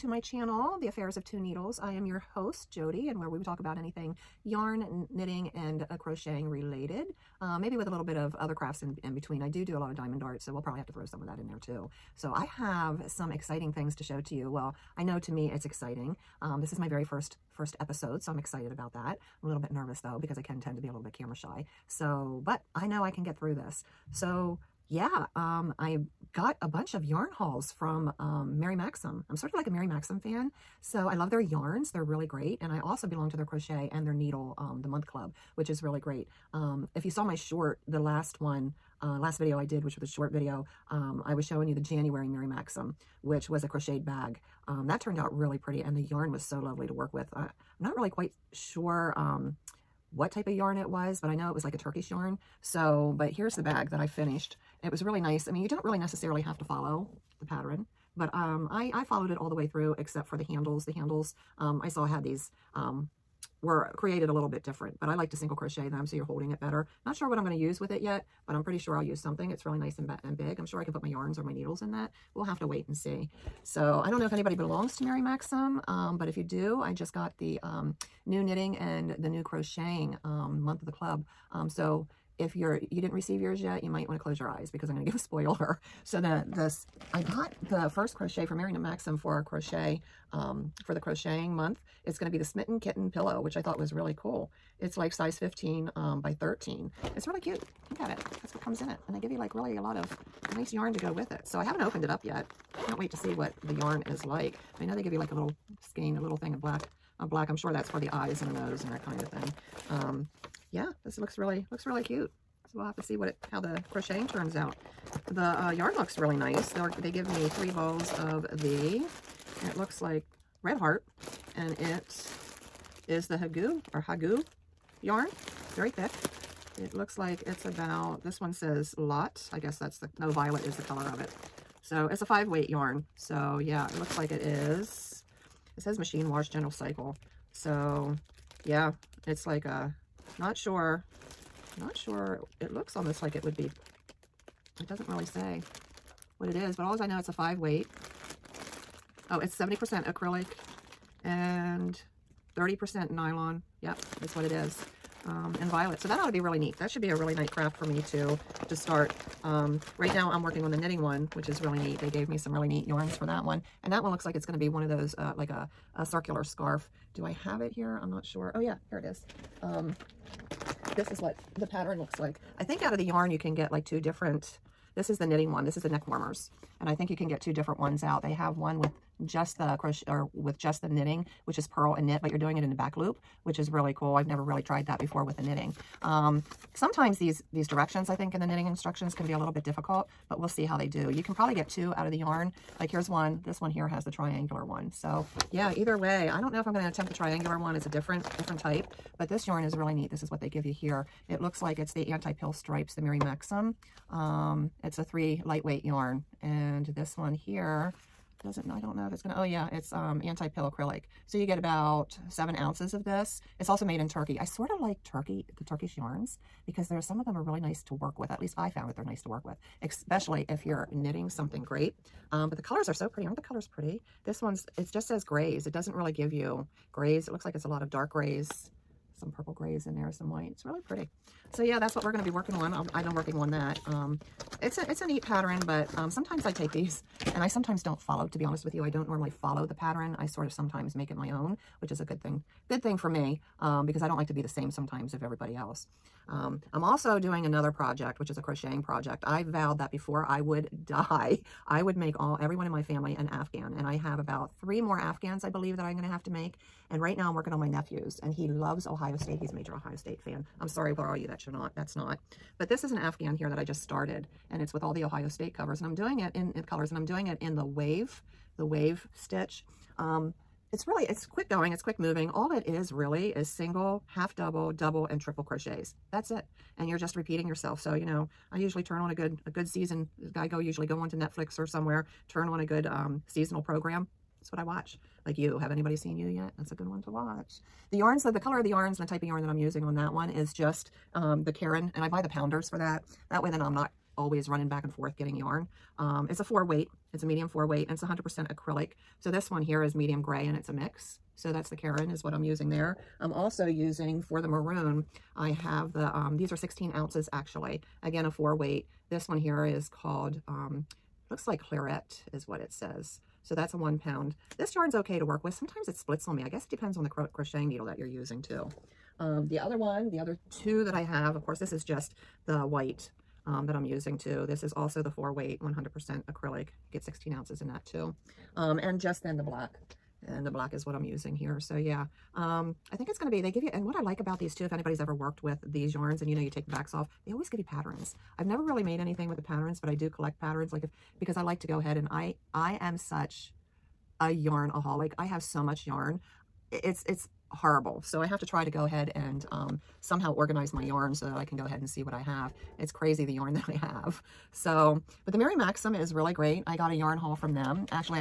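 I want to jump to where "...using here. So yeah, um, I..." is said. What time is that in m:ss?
5:31.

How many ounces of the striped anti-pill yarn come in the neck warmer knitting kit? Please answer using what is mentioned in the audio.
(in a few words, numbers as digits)
7.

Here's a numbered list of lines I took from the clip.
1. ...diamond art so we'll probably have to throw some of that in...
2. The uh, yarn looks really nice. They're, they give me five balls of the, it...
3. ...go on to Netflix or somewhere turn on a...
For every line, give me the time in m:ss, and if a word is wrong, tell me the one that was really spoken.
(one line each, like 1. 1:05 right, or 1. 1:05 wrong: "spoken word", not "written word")
1. 0:09 right
2. 1:55 wrong: "three", not "five"
3. 4:40 right.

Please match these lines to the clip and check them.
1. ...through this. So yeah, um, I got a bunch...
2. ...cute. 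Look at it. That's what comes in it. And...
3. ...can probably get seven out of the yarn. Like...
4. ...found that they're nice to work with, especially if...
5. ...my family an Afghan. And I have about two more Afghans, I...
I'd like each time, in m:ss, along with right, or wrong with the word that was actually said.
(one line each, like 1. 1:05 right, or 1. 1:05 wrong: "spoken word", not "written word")
1. 0:23 right
2. 1:37 right
3. 3:11 wrong: "two", not "seven"
4. 3:38 right
5. 4:12 wrong: "three", not "two".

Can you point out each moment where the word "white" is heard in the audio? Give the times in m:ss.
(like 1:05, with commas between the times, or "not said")
3:50, 5:22.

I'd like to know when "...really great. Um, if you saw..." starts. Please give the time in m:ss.
0:35.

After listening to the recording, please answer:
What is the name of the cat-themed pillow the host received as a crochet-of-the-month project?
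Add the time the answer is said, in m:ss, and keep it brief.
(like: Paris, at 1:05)
Smitten Kitten Pillow, at 1:32.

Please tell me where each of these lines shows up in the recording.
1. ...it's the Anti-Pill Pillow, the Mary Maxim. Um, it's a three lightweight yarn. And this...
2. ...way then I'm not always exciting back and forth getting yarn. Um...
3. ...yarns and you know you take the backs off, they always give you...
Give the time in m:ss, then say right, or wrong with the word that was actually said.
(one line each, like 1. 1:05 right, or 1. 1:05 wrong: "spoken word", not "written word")
1. 3:21 wrong: "Stripes", not "Pillow"
2. 4:53 wrong: "running", not "exciting"
3. 5:35 right.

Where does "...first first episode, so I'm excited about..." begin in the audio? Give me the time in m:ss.
0:17.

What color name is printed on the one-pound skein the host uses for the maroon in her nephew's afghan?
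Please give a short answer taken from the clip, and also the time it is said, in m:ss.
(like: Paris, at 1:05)
Claret, at 5:11.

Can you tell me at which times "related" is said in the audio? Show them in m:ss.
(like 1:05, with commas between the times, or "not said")
0:06.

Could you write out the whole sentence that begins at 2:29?
Oh, it's 70% acrylic and 30% nylon.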